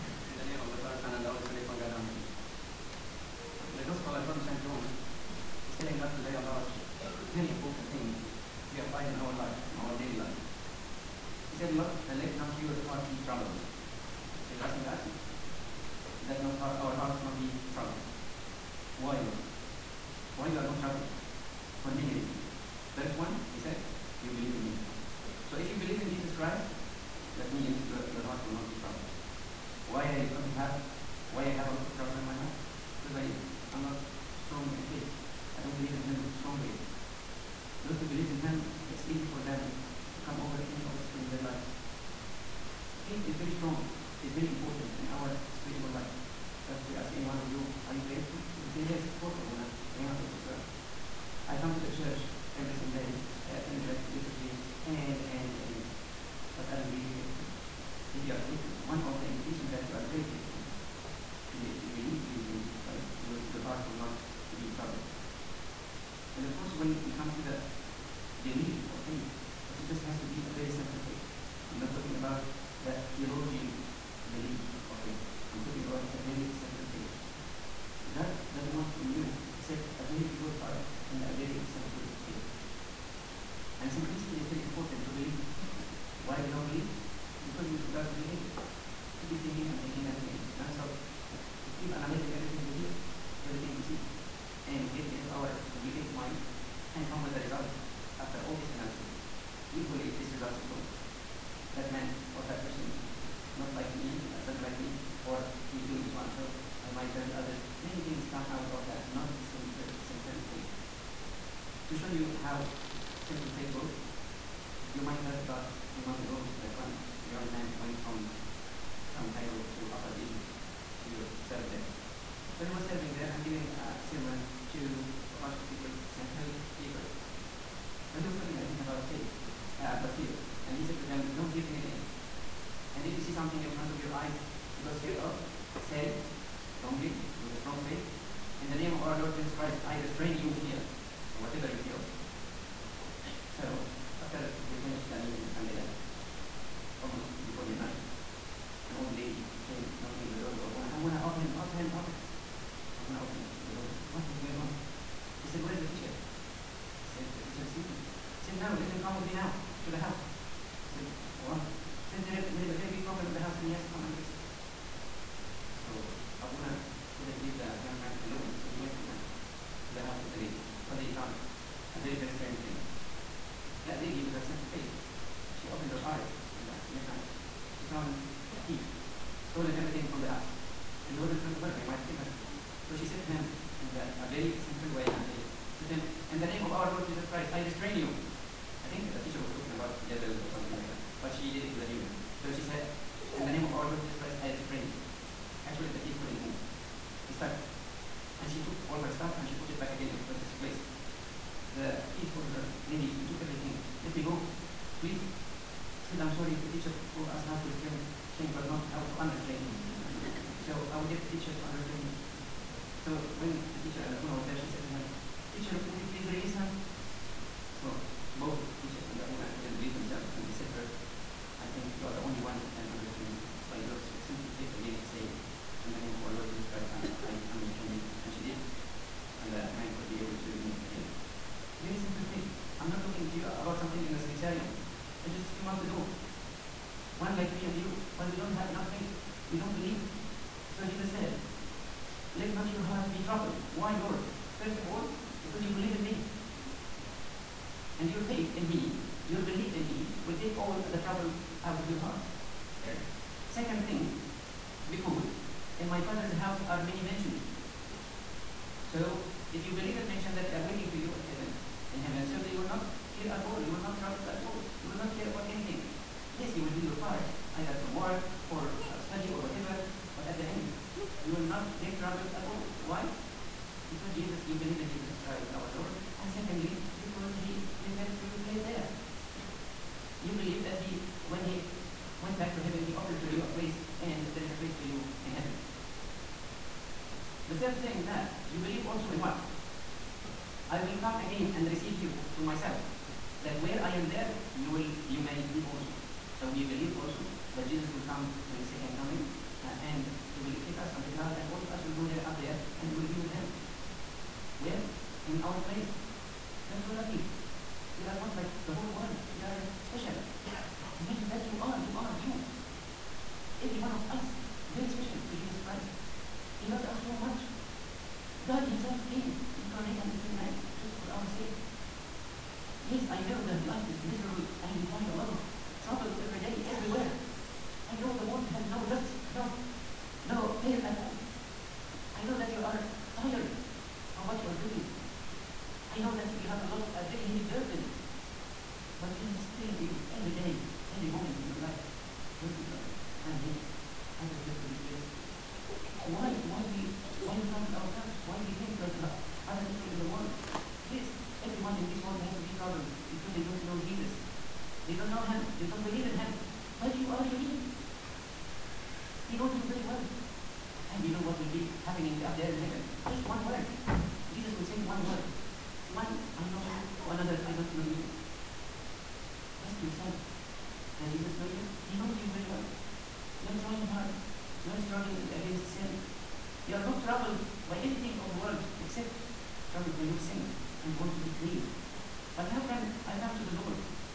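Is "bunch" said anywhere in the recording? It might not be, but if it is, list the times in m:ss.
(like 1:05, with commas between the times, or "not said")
2:05.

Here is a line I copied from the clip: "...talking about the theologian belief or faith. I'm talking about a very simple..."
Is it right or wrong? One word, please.
right.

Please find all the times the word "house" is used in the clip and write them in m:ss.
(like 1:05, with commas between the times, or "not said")
3:00, 4:16.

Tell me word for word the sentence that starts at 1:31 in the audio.
We keep analyzing everything we hear, everything we see.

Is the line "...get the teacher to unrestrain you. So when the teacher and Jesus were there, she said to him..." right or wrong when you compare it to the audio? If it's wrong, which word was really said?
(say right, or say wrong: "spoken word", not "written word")
wrong: "Abuna", not "Jesus".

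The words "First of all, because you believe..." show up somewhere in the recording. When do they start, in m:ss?
4:04.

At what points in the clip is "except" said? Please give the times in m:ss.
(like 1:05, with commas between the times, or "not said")
1:19, 6:18.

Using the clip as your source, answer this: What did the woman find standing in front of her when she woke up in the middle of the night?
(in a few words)
A thief.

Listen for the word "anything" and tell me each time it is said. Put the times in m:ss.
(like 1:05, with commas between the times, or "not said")
2:11, 4:25, 6:17.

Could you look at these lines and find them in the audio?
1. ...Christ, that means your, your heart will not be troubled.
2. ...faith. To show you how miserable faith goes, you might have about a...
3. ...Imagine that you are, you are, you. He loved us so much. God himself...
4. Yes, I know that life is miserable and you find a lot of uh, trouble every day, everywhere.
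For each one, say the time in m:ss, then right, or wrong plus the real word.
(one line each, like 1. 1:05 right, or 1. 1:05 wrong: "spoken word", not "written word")
1. 0:26 right
2. 1:50 wrong: "simple", not "miserable"
3. 5:10 right
4. 5:22 right.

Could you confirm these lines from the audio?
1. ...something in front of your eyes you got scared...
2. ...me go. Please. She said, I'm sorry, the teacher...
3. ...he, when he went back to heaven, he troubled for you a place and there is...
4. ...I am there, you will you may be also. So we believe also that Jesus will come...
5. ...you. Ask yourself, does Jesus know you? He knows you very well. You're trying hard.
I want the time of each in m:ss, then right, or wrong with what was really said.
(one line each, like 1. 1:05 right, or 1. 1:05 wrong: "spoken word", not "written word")
1. 2:13 right
2. 3:24 right
3. 4:40 wrong: "opened", not "troubled"
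4. 4:53 right
5. 6:07 right.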